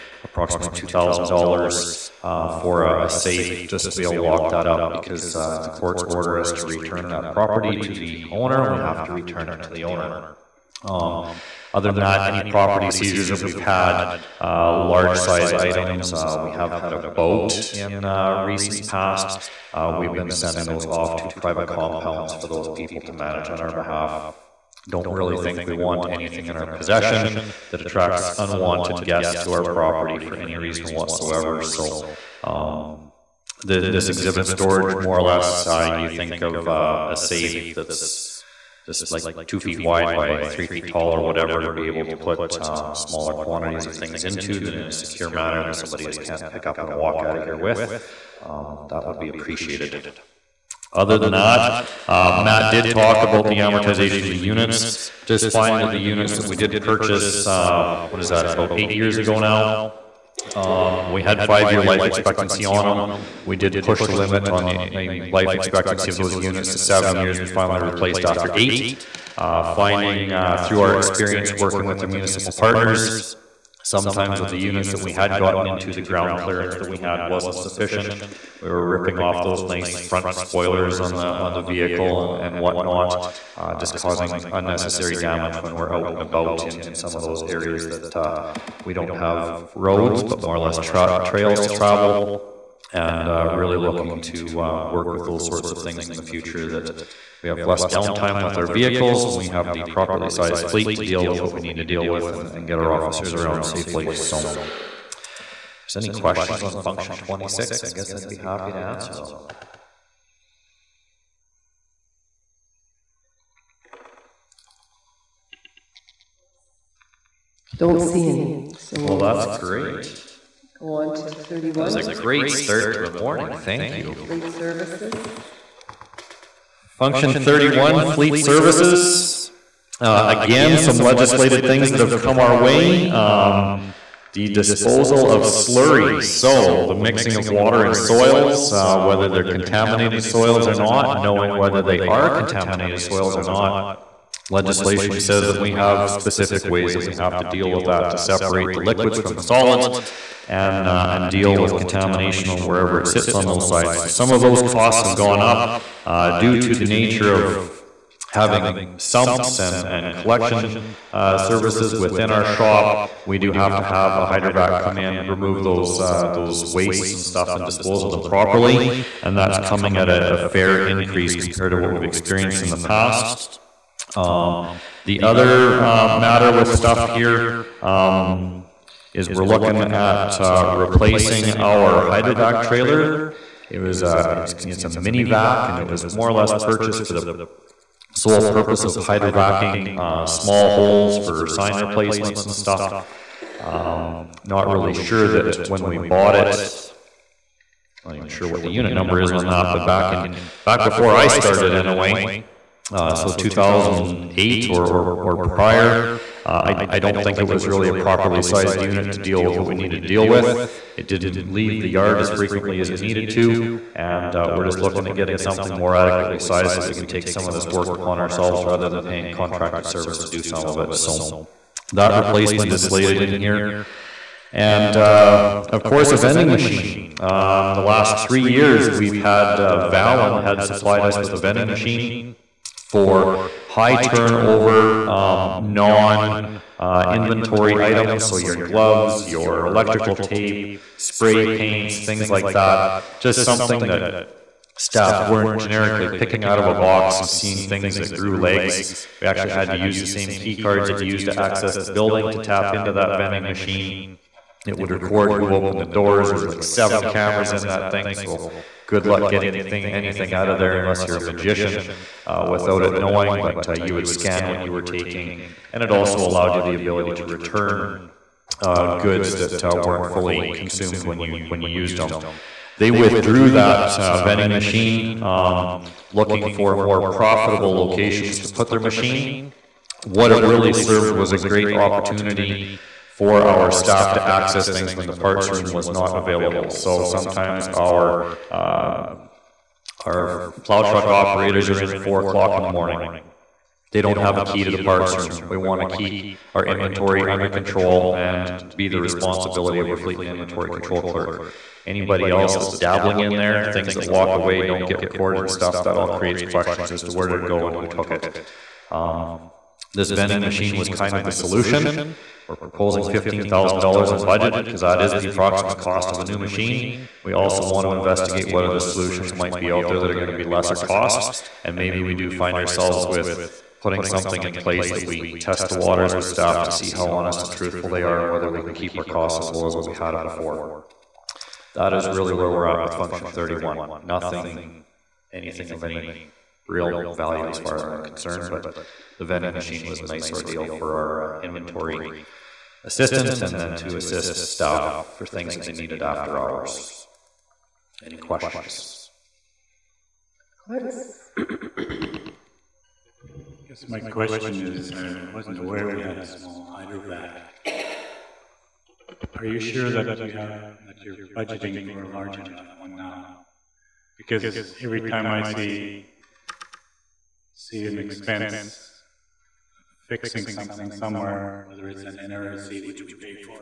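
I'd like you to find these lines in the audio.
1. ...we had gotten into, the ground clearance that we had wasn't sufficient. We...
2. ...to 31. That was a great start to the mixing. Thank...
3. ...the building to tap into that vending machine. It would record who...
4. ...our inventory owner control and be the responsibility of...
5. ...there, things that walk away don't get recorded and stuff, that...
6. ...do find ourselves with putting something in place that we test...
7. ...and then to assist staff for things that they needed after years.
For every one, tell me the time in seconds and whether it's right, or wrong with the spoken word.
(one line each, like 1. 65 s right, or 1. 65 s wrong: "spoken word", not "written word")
1. 74 s right
2. 121 s wrong: "morning", not "mixing"
3. 251 s right
4. 296 s wrong: "under", not "owner"
5. 303 s right
6. 322 s right
7. 343 s wrong: "hours", not "years".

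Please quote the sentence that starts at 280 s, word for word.
What it really served was a great opportunity for our staff to access things when the parts room was not available.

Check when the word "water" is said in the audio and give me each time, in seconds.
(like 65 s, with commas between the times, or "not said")
137 s, 325 s.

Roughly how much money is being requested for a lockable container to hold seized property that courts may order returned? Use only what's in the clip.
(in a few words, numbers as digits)
$2,000.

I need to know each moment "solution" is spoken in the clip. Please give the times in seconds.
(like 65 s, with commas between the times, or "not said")
311 s, 318 s.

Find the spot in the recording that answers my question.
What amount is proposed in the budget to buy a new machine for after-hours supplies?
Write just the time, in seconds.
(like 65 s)
313 s.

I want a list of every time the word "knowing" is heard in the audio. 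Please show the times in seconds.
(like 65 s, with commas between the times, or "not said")
141 s, 262 s.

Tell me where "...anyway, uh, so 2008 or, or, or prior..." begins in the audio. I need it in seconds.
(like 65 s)
201 s.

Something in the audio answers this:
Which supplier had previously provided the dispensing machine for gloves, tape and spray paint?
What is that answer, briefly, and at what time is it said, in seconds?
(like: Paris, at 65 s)
Valen, at 229 s.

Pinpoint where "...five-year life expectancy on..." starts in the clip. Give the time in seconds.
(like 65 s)
61 s.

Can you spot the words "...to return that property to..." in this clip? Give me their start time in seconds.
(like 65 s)
6 s.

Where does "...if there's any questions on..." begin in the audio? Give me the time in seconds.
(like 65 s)
104 s.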